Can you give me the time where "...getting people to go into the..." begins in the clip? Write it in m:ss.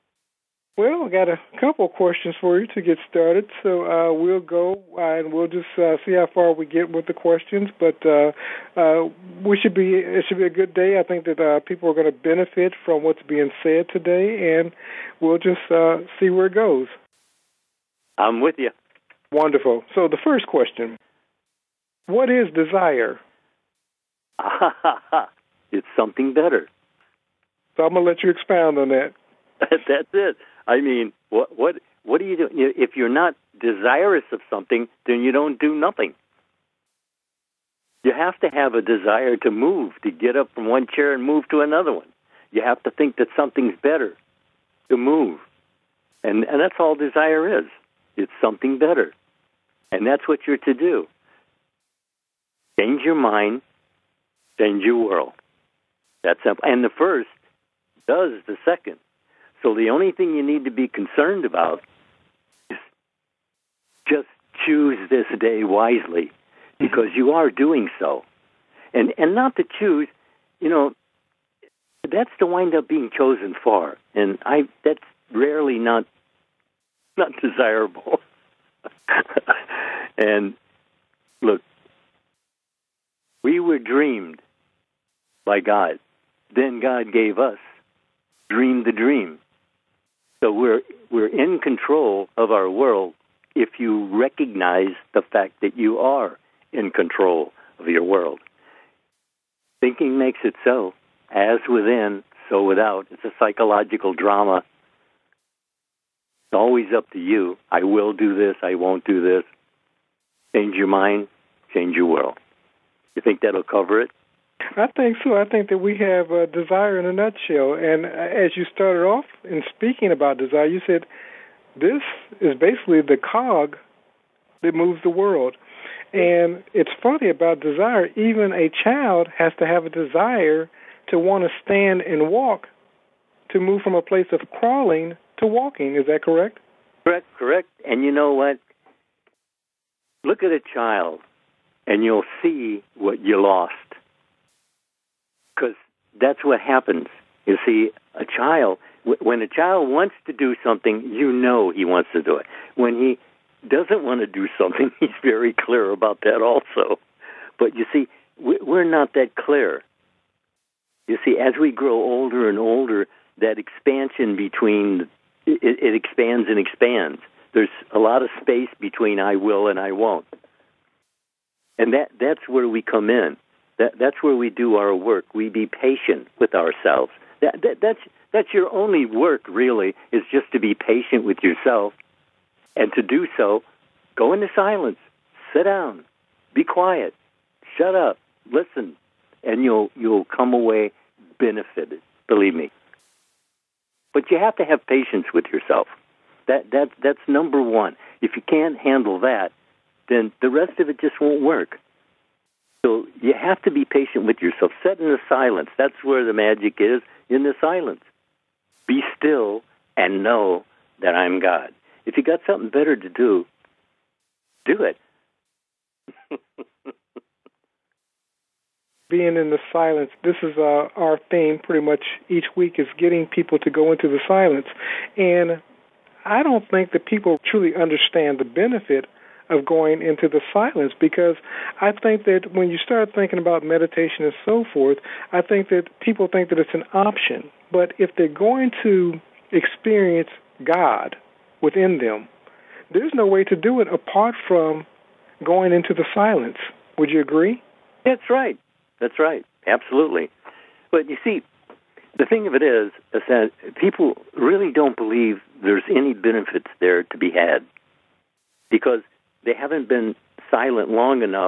3:42.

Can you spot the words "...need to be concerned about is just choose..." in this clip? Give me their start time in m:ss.
1:00.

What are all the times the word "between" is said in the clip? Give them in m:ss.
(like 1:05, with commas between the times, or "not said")
2:44, 2:48.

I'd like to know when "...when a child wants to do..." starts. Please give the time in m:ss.
2:29.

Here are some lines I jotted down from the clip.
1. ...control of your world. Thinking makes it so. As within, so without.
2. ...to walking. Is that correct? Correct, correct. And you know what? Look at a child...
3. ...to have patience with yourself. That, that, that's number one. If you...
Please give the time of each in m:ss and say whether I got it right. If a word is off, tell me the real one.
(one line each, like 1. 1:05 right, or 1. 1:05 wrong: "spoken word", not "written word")
1. 1:36 right
2. 2:15 right
3. 3:14 right.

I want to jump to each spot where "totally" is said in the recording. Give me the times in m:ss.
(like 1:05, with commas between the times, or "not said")
not said.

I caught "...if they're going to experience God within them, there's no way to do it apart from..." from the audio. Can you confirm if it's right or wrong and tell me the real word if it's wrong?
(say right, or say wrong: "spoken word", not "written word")
right.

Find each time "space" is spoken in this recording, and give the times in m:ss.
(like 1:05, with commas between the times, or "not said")
2:48.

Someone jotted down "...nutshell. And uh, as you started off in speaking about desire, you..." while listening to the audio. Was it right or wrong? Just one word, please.
right.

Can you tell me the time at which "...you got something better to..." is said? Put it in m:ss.
3:32.